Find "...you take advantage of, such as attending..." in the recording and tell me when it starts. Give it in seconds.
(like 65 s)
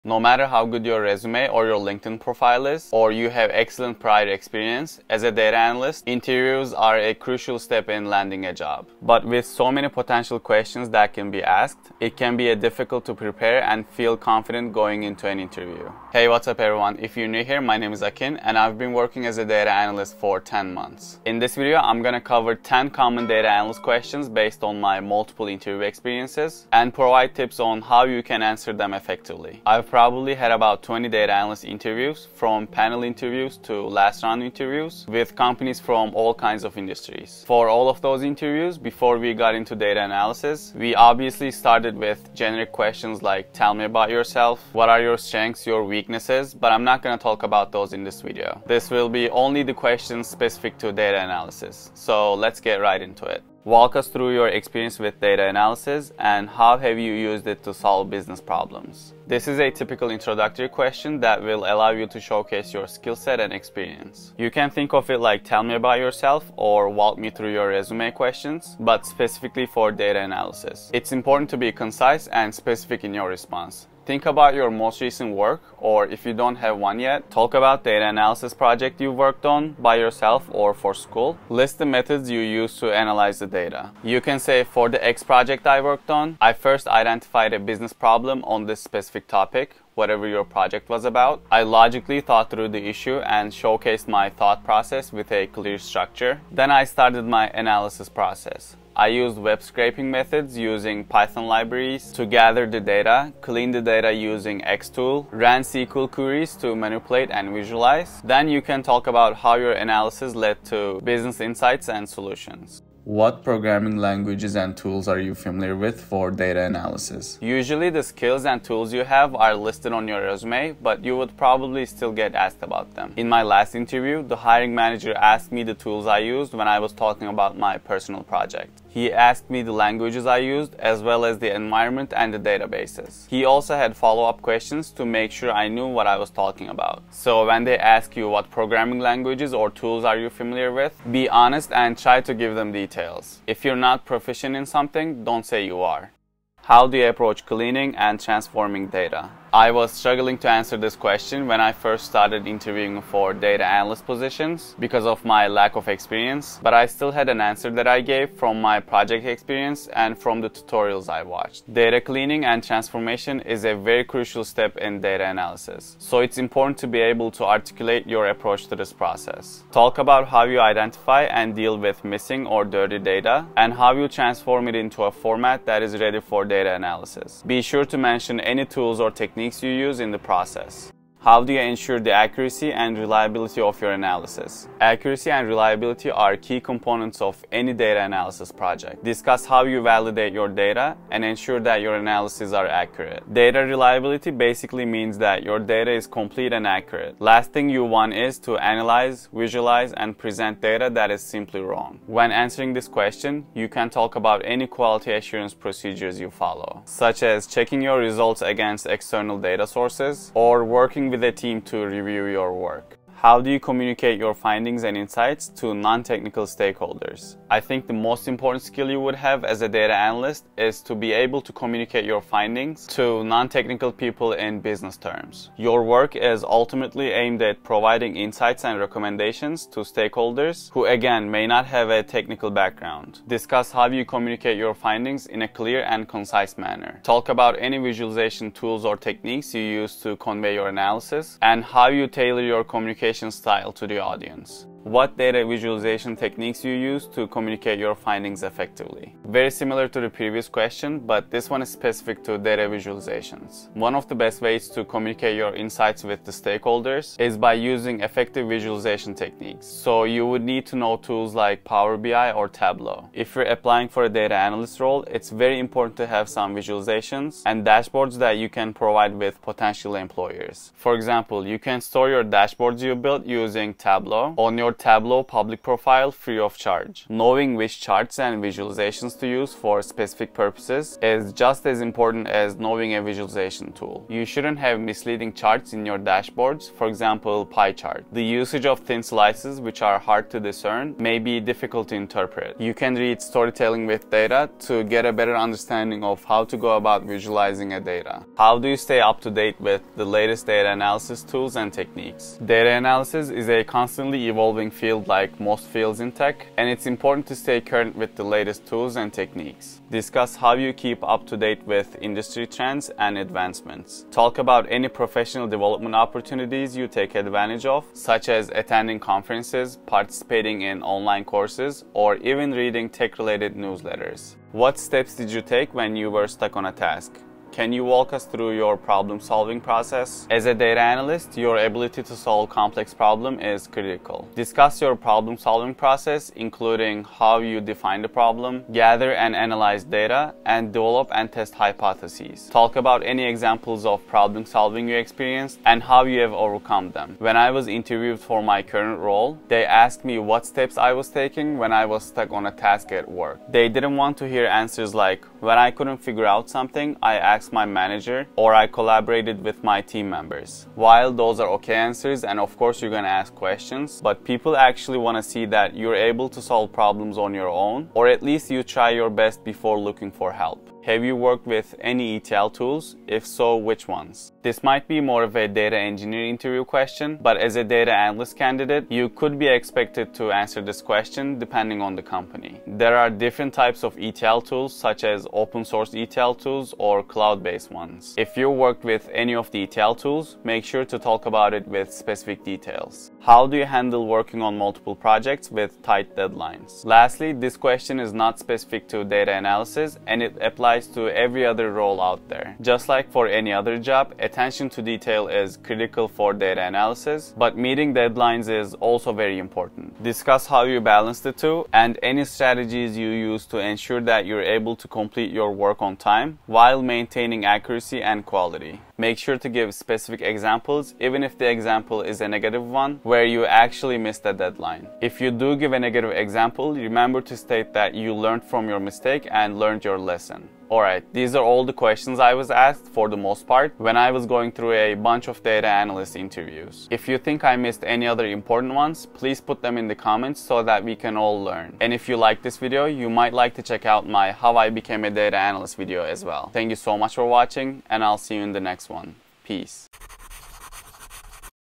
316 s.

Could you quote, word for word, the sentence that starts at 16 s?
If you're new here, my name is Akin and I've been working as a data analyst for 10 months.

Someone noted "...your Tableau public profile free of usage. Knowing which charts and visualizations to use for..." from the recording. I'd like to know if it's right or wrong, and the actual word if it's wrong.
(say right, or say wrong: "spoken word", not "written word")
wrong: "charge", not "usage".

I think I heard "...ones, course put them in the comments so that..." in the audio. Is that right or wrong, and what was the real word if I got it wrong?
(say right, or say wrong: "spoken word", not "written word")
wrong: "please", not "course".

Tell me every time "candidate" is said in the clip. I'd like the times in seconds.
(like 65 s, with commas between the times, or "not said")
378 s.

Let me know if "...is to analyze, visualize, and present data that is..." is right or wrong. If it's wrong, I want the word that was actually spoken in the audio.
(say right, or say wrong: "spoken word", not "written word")
right.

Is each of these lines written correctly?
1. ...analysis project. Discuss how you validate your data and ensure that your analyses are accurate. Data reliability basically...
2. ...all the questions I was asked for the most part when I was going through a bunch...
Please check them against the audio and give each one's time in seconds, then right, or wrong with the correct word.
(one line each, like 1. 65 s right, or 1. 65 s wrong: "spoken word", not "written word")
1. 188 s right
2. 431 s right.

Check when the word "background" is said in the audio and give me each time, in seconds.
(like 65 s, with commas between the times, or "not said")
232 s.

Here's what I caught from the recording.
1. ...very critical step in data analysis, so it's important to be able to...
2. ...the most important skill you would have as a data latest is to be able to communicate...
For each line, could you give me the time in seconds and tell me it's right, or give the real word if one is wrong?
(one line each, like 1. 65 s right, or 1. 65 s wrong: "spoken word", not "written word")
1. 163 s wrong: "crucial", not "critical"
2. 217 s wrong: "analyst", not "latest".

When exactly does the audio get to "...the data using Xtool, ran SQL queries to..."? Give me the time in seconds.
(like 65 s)
103 s.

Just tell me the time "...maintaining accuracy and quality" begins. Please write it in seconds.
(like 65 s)
416 s.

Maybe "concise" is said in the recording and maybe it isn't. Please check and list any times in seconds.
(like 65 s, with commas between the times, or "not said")
71 s, 236 s.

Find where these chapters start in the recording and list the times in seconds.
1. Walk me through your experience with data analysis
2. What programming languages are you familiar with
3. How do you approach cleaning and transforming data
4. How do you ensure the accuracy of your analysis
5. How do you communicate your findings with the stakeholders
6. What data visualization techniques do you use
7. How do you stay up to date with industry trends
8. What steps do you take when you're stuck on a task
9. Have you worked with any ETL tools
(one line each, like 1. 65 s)
1. 55 s
2. 115 s
3. 147 s
4. 182 s
5. 214 s
6. 246 s
7. 299 s
8. 325 s
9. 372 s.